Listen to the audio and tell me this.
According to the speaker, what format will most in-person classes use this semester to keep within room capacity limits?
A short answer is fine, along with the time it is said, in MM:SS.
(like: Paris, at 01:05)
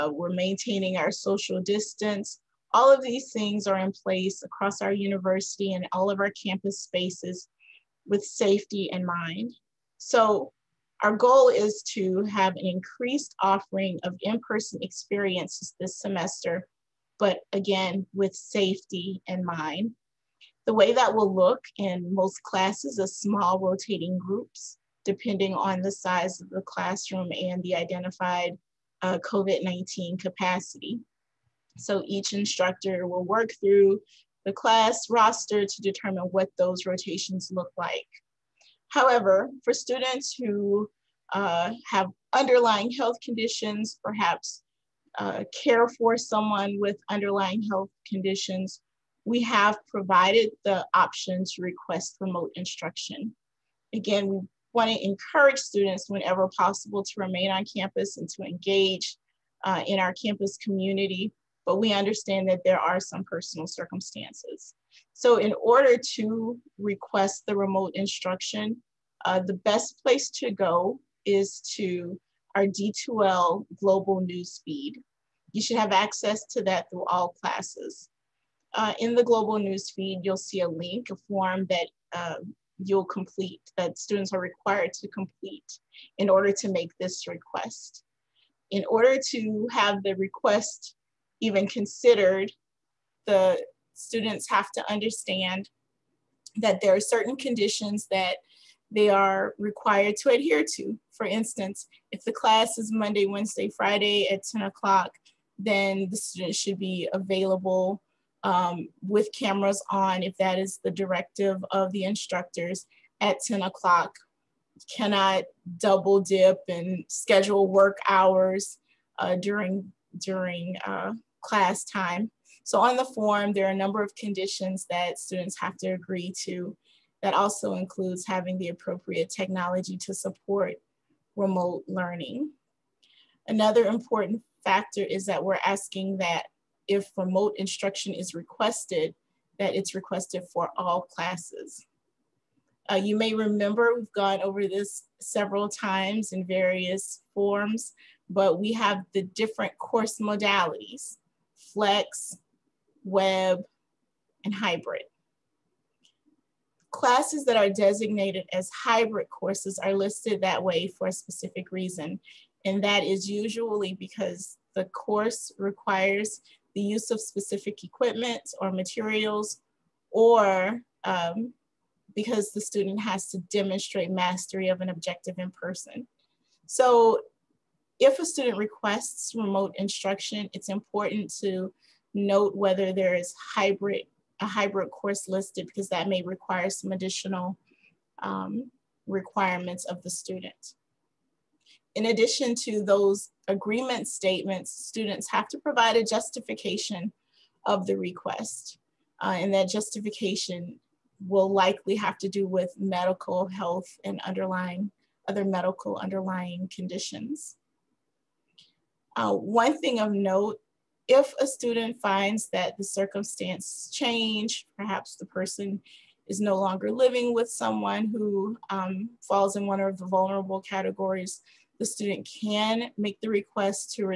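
small rotating groups, at 00:23.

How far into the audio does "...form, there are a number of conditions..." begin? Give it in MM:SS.
02:03.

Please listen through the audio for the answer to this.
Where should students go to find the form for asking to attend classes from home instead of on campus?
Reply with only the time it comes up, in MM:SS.
01:12.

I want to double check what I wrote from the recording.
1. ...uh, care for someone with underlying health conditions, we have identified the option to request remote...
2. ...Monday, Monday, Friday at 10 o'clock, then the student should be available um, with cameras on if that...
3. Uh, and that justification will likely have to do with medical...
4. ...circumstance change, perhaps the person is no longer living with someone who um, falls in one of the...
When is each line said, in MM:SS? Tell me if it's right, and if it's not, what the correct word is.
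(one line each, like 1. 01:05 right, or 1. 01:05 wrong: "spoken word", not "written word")
1. 00:45 wrong: "provided", not "identified"
2. 01:42 wrong: "Wednesday", not "Monday"
3. 03:19 right
4. 03:32 right.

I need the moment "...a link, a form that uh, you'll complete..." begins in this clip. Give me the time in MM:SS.
01:20.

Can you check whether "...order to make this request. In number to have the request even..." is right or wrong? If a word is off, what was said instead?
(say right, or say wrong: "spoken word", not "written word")
wrong: "order", not "number".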